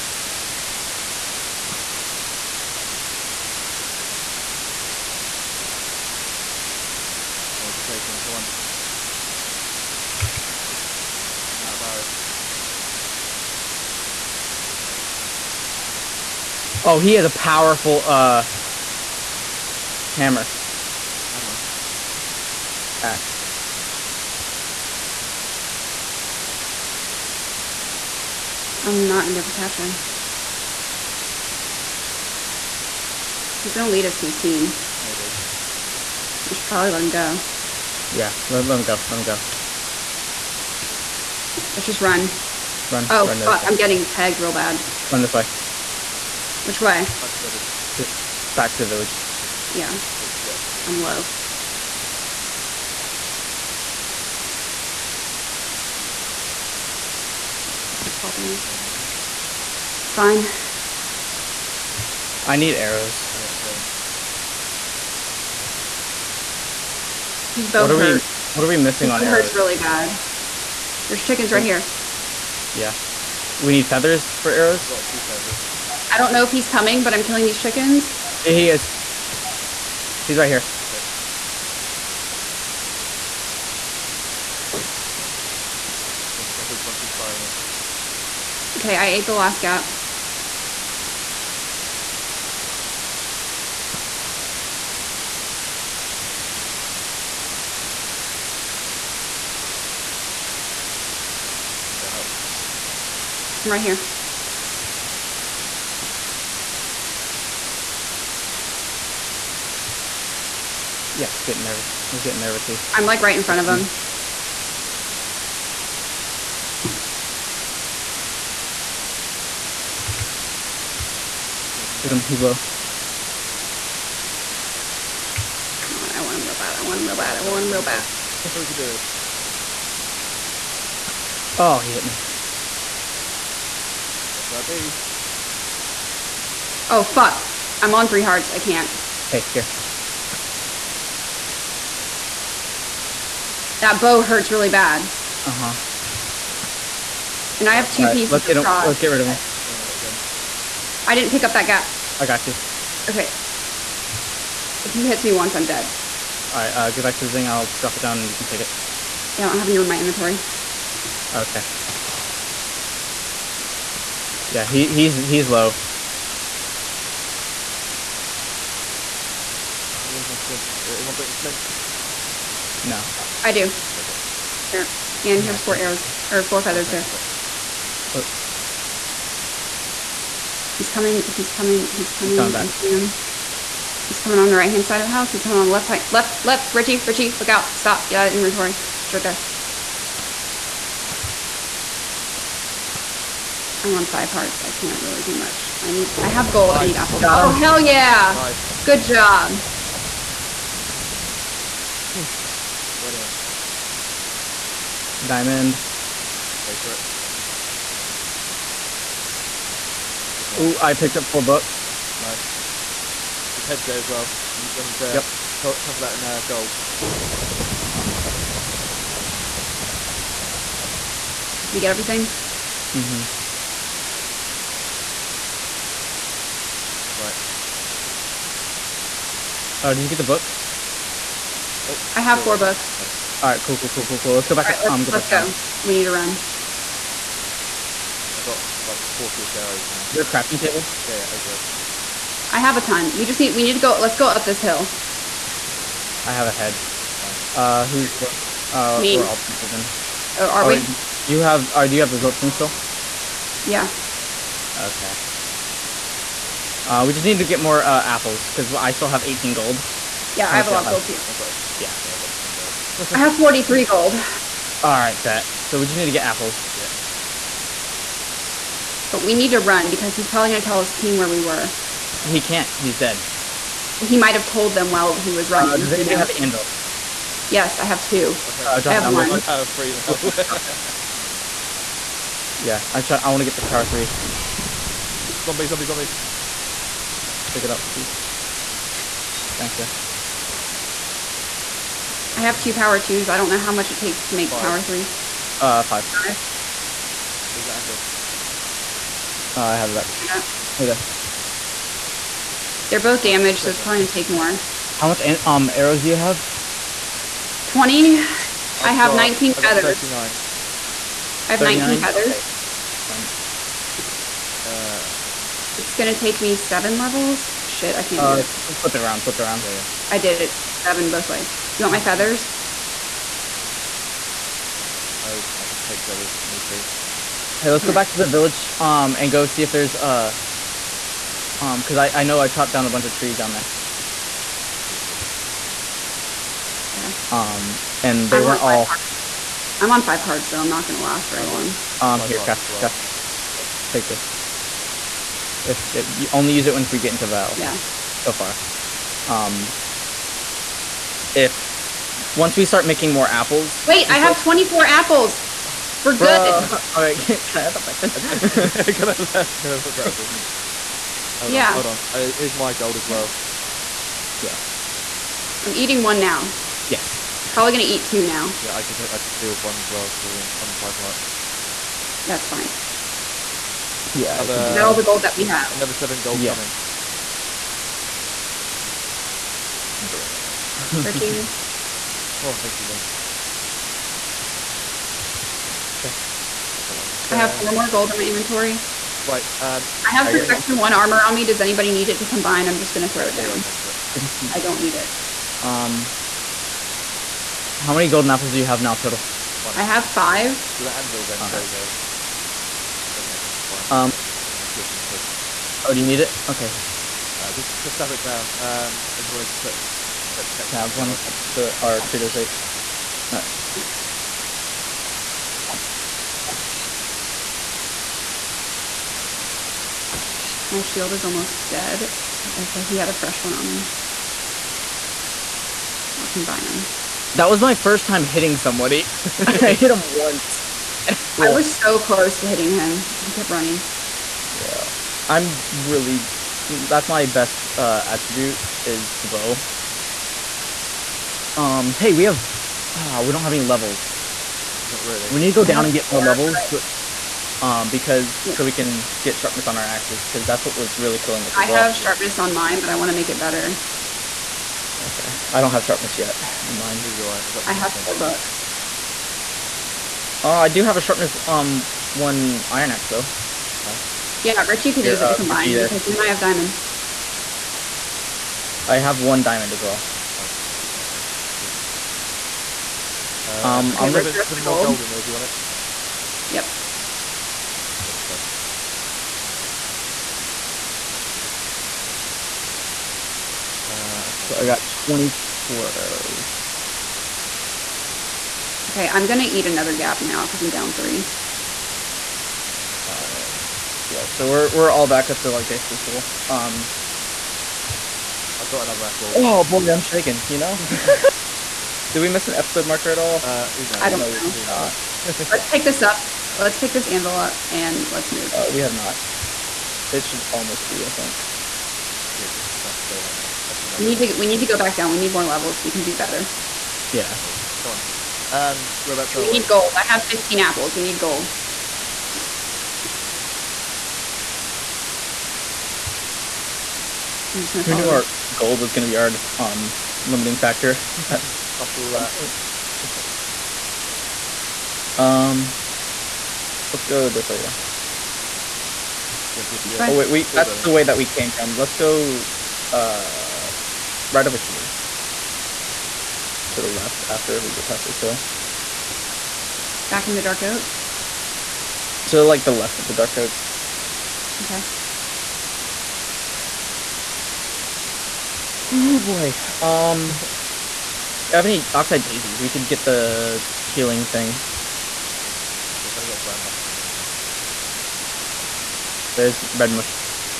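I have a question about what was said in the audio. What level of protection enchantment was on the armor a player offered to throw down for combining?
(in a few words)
1.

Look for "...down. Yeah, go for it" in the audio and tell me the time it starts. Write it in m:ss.
6:33.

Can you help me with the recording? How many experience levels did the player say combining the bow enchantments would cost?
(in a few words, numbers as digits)
7.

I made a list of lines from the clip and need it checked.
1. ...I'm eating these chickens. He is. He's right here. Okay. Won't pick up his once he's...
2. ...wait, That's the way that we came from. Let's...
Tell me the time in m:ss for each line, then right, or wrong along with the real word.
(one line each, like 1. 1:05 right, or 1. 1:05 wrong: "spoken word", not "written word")
1. 1:17 wrong: "killing", not "eating"
2. 9:00 right.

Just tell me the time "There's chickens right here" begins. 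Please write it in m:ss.
1:11.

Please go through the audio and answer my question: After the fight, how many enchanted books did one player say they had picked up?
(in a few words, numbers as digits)
4.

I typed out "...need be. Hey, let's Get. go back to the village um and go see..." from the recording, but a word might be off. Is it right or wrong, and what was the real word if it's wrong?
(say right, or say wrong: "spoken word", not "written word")
wrong: "Here", not "Get".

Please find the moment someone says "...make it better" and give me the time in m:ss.
7:33.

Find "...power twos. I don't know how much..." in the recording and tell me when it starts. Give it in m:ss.
4:52.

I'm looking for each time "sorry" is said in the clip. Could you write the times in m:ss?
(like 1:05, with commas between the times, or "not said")
6:41, 7:58.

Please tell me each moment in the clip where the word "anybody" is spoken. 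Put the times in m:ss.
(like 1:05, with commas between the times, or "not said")
4:35, 6:31.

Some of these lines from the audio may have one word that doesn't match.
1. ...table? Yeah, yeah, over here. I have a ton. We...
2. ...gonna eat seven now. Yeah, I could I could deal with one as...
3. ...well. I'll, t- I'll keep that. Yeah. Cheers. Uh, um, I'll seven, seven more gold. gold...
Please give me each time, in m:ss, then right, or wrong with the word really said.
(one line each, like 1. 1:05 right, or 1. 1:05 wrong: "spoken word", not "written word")
1. 4:00 right
2. 6:07 wrong: "two", not "seven"
3. 7:49 right.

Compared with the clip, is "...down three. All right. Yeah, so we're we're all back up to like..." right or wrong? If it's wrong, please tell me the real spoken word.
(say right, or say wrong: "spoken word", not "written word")
right.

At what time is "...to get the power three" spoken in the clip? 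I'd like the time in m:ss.
4:43.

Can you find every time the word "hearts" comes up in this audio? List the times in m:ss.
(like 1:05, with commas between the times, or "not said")
2:18, 3:14, 6:10.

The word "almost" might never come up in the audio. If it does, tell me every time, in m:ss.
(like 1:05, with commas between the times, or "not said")
7:01, 8:30.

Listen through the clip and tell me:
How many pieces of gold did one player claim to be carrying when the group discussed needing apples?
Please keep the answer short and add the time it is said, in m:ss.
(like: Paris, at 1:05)
43, at 4:23.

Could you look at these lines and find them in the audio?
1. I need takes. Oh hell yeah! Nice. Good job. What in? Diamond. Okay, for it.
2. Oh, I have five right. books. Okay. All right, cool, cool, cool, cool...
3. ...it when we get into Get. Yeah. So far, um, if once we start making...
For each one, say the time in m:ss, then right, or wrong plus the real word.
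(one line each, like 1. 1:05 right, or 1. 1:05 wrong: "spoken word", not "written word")
1. 3:16 wrong: "apples", not "takes"
2. 3:51 wrong: "four", not "five"
3. 5:46 wrong: "Val", not "Get".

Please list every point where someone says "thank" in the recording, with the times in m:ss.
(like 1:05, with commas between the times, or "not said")
4:49, 6:22.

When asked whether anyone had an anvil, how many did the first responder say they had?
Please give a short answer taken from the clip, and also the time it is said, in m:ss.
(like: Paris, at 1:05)
2, at 4:37.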